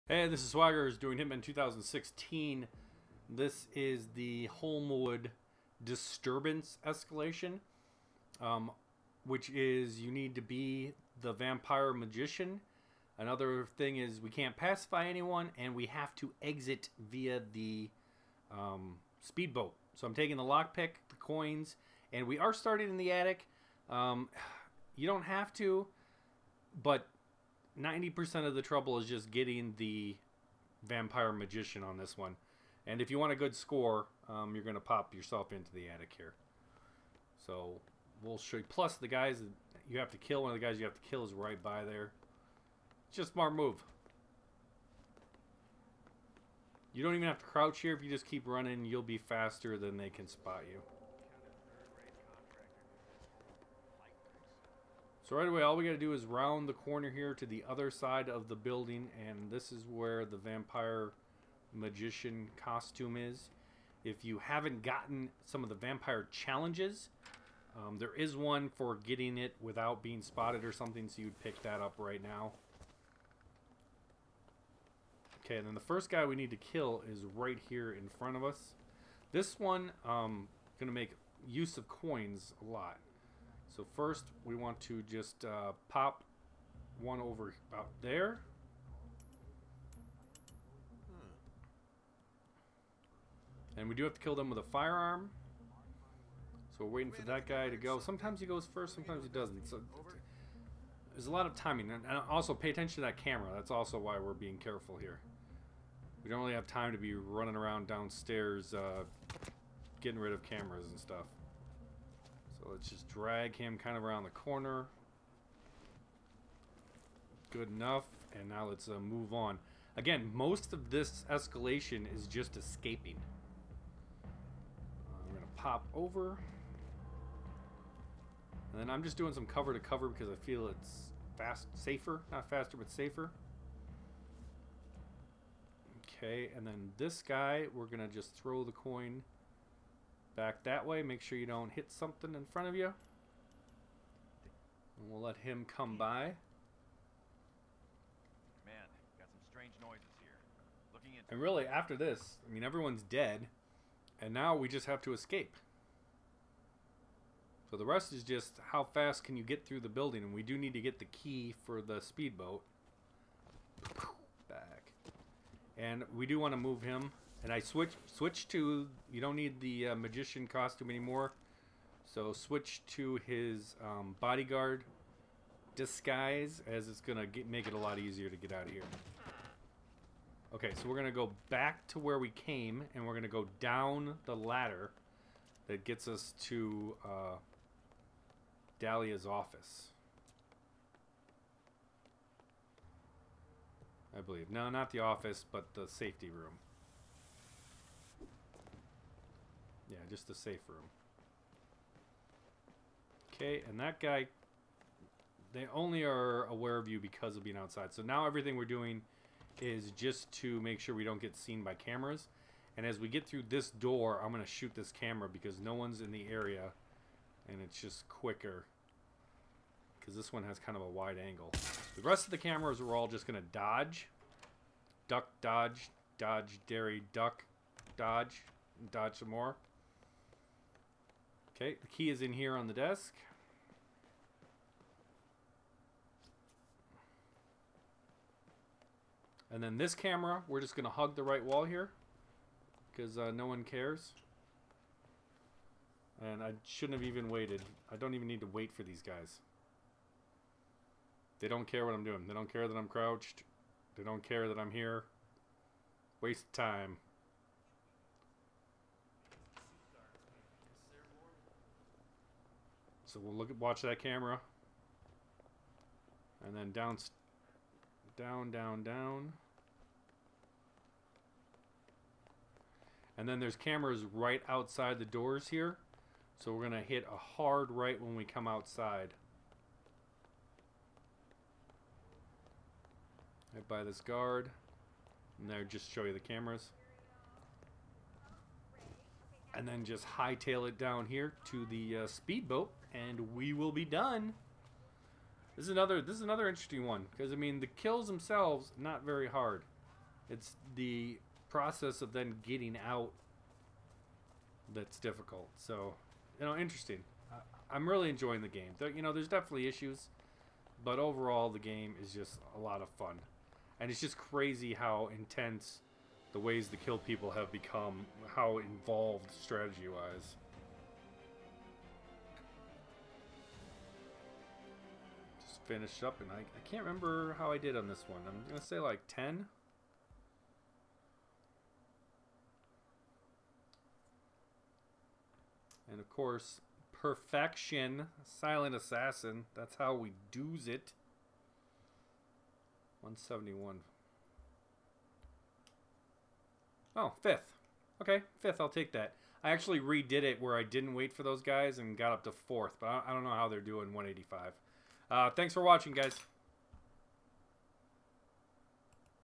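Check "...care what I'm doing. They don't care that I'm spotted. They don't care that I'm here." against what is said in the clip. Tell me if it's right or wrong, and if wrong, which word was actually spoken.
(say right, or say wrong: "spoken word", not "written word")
wrong: "crouched", not "spotted".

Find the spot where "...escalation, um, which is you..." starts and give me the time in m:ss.
0:06.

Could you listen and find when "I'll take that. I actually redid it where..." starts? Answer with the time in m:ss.
5:48.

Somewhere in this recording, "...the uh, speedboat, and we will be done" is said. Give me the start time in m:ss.
4:51.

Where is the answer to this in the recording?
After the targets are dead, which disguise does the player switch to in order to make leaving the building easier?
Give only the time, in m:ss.
2:54.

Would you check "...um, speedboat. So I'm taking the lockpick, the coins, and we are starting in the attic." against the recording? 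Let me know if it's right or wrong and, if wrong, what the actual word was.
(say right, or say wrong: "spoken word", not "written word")
right.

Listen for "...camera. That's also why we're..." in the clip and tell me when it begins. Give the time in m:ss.
1:43.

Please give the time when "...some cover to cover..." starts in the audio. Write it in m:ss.
2:09.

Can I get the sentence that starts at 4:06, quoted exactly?
And I shouldn't have even waited.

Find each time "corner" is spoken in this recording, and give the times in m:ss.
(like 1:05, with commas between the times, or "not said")
0:56, 1:54.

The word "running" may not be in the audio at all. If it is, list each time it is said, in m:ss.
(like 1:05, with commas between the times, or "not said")
0:48, 1:47.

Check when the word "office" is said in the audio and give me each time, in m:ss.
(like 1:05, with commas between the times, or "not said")
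3:09, 3:14.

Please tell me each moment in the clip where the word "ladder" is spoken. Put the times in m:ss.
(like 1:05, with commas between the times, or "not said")
3:04.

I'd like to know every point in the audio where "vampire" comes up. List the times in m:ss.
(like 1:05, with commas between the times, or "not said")
0:11, 0:30, 1:00, 1:05.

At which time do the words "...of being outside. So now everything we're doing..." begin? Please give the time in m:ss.
3:27.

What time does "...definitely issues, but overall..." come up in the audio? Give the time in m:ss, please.
5:09.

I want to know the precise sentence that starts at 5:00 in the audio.
It's the process of then getting out that's difficult.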